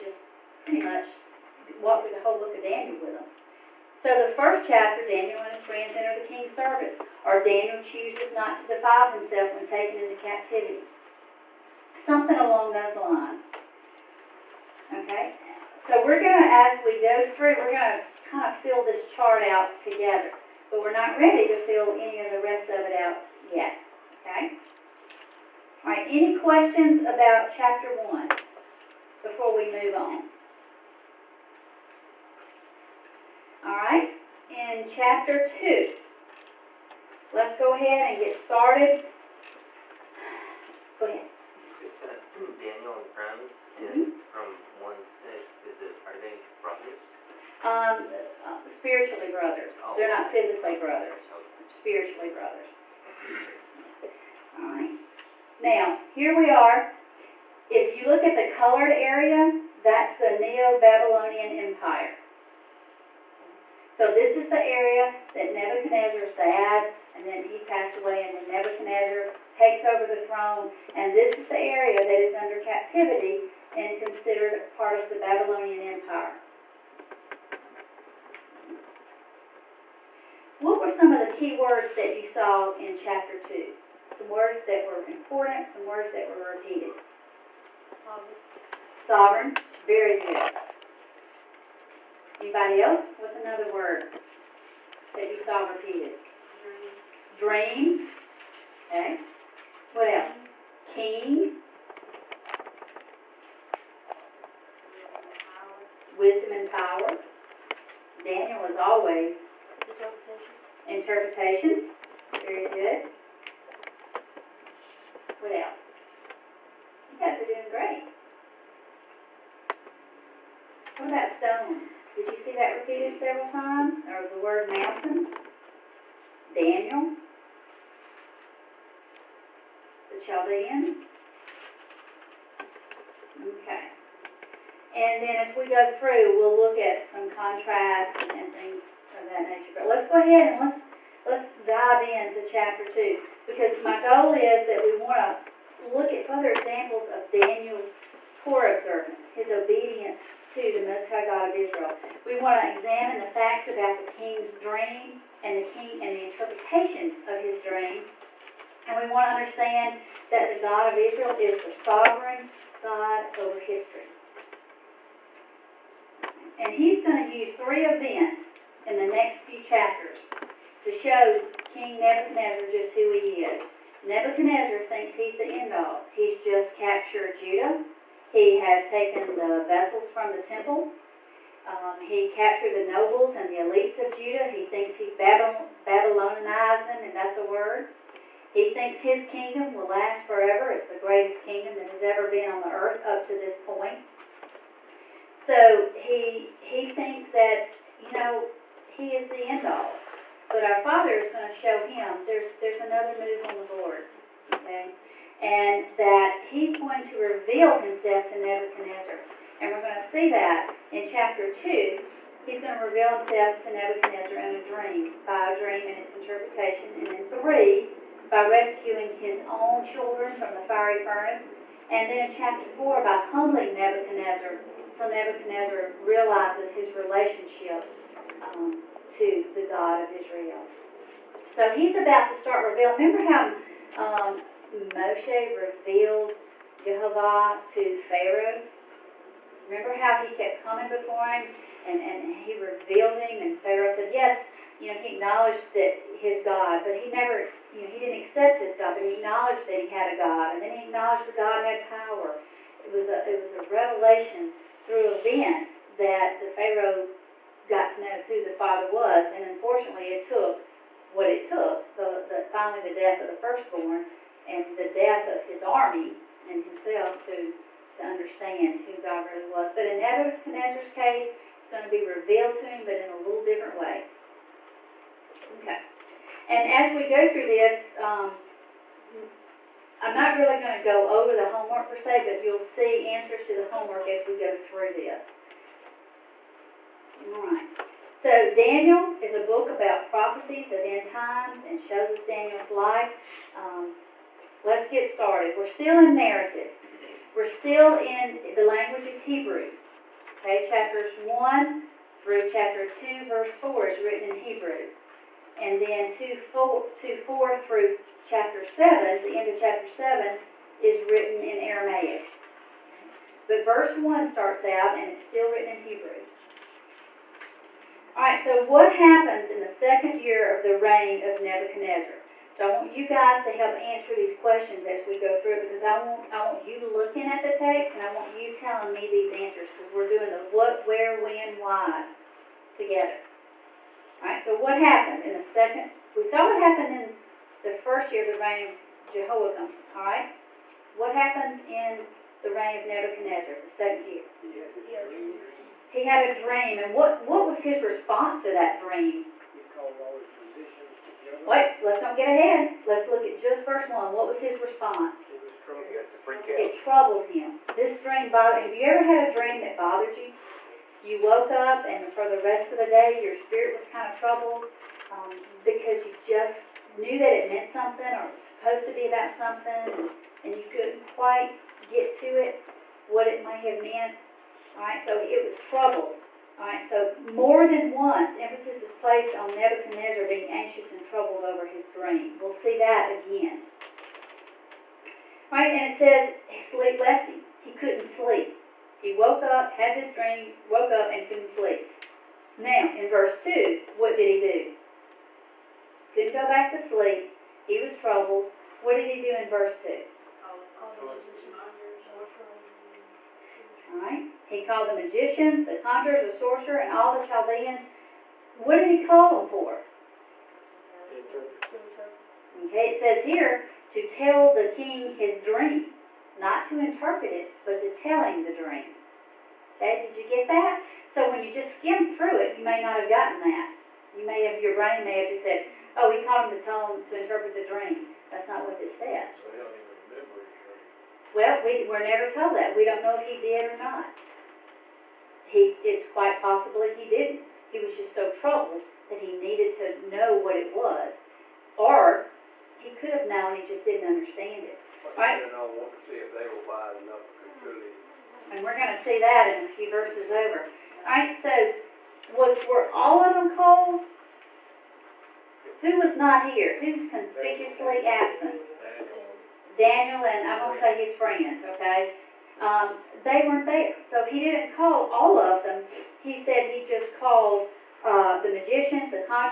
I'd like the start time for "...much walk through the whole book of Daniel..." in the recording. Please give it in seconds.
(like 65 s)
0 s.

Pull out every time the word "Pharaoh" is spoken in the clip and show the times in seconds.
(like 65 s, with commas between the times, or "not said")
238 s, 243 s, 256 s.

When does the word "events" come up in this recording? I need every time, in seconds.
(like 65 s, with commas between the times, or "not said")
167 s, 255 s.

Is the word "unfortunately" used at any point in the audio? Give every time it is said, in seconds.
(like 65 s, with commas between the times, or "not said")
259 s.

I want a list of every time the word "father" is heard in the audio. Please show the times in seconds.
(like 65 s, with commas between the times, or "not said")
200 s, 258 s.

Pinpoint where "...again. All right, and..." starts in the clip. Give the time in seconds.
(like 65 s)
383 s.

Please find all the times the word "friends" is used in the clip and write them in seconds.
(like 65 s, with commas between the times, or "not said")
5 s, 43 s, 461 s.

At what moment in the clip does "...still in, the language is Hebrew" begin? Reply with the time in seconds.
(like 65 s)
297 s.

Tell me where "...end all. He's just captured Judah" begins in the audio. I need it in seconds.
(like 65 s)
175 s.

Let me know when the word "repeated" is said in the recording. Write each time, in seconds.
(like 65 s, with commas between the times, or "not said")
86 s, 95 s, 122 s.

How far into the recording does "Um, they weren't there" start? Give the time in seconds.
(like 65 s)
462 s.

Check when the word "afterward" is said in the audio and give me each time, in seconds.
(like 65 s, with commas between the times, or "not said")
not said.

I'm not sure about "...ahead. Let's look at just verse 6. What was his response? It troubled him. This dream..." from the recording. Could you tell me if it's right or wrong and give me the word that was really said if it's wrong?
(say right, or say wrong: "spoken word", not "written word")
wrong: "1", not "6".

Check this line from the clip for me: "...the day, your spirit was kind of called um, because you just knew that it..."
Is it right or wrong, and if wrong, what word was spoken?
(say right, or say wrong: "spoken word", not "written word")
wrong: "troubled", not "called".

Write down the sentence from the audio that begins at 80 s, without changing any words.
What were some of the key words that you saw in chapter 2?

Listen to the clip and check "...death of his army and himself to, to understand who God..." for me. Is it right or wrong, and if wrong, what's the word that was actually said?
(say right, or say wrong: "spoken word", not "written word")
right.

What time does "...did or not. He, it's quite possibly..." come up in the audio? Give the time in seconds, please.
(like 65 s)
433 s.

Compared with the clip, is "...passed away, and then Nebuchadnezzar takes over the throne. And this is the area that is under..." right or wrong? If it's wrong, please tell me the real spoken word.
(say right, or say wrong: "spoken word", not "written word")
right.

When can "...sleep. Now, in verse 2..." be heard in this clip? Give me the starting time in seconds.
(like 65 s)
391 s.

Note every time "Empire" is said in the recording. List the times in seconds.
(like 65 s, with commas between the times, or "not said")
61 s, 75 s.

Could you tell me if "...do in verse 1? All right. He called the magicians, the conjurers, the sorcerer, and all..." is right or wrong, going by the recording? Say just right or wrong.
wrong.